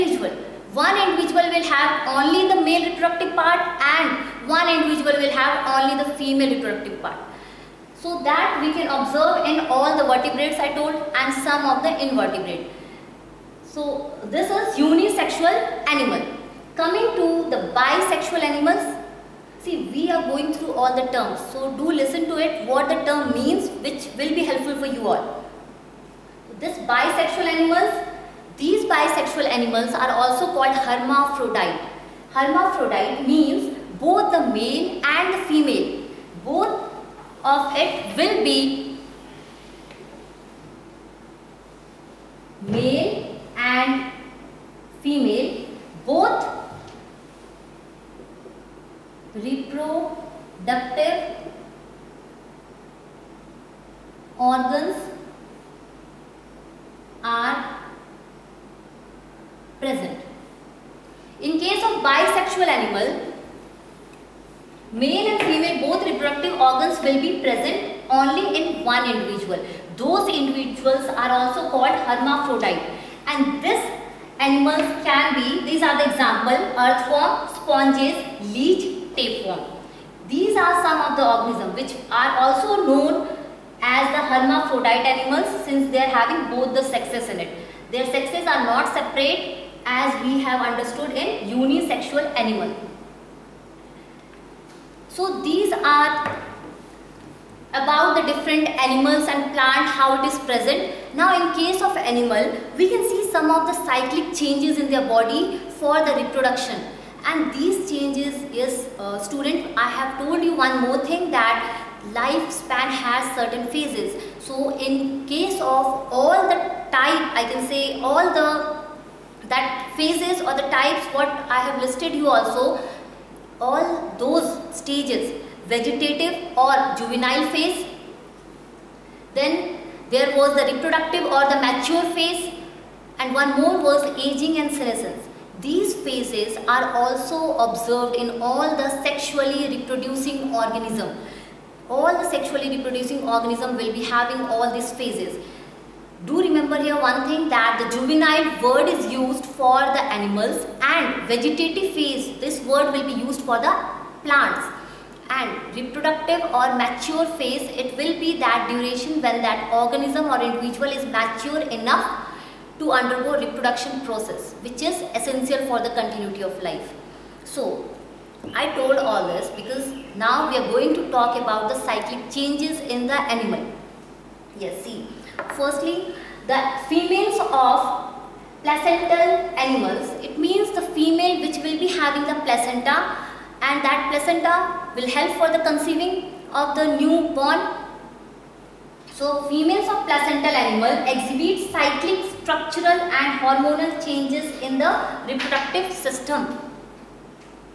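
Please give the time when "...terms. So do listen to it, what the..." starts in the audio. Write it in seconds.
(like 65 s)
21 s.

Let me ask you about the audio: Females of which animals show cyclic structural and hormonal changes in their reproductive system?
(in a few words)
Placental animals.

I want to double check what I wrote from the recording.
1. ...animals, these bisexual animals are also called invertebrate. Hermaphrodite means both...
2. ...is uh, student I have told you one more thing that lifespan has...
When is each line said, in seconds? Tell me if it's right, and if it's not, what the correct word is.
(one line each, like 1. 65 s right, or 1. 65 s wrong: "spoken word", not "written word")
1. 27 s wrong: "hermaphrodite", not "invertebrate"
2. 108 s right.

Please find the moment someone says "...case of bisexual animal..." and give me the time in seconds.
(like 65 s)
61 s.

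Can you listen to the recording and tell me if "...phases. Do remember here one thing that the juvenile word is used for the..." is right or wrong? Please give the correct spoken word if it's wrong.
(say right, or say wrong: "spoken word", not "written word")
right.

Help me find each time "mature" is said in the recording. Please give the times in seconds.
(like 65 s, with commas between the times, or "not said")
131 s, 156 s, 161 s.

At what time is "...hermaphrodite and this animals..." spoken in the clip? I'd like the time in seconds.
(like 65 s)
72 s.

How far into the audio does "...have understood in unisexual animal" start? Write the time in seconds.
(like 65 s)
90 s.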